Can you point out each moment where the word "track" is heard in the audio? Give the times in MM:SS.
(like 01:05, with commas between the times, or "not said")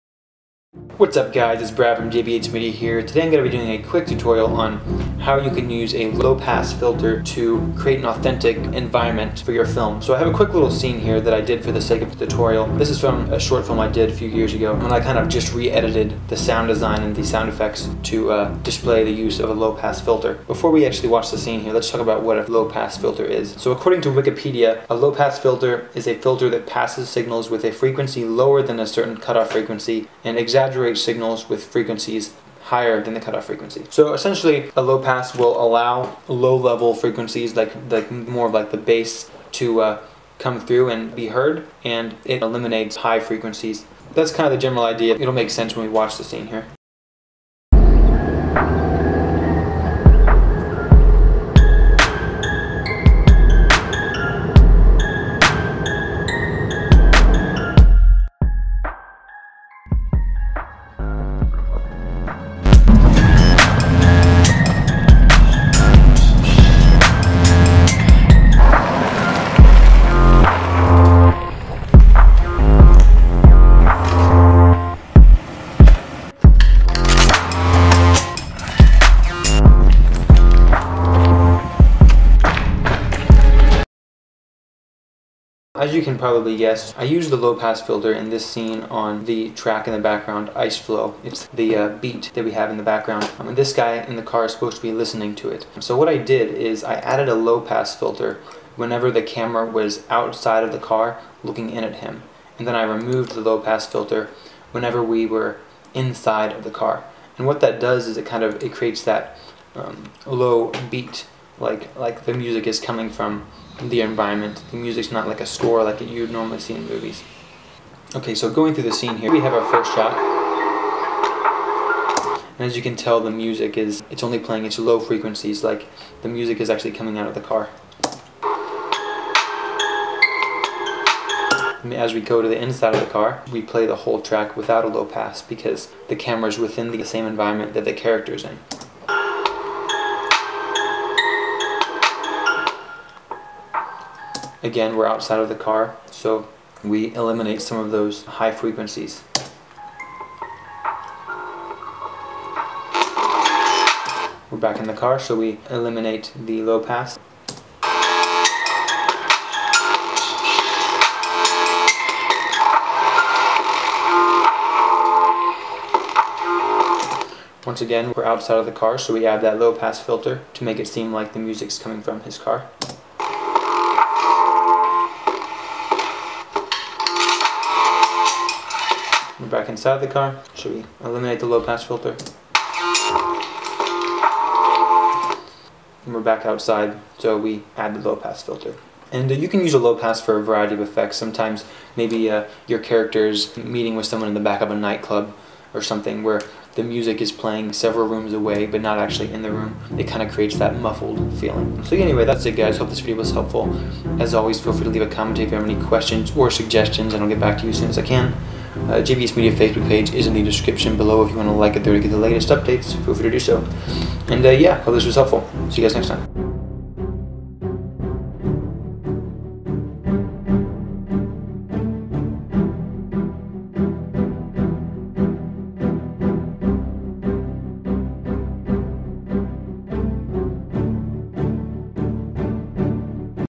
01:29, 02:14.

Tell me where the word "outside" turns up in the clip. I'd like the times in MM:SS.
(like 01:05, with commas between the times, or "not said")
01:40, 02:25, 02:48, 03:06.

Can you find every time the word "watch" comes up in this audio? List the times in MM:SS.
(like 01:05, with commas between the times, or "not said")
00:21, 00:45.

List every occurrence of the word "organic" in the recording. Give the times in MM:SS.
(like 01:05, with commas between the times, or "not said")
not said.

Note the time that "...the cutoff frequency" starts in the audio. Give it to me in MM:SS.
00:33.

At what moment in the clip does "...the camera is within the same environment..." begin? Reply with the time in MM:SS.
02:16.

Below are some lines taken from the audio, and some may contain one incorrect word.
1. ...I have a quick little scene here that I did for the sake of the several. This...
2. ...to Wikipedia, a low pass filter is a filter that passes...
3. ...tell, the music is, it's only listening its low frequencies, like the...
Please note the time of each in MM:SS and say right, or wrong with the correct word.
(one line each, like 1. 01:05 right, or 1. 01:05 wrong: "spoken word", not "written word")
1. 00:10 wrong: "tutorial", not "several"
2. 00:24 right
3. 02:02 wrong: "playing", not "listening".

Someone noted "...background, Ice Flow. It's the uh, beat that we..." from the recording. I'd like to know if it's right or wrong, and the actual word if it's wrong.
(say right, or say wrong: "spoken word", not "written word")
right.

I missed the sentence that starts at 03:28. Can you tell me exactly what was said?
Uh, JBH Media Facebook page is in the description below if you want to like it there to get the latest updates.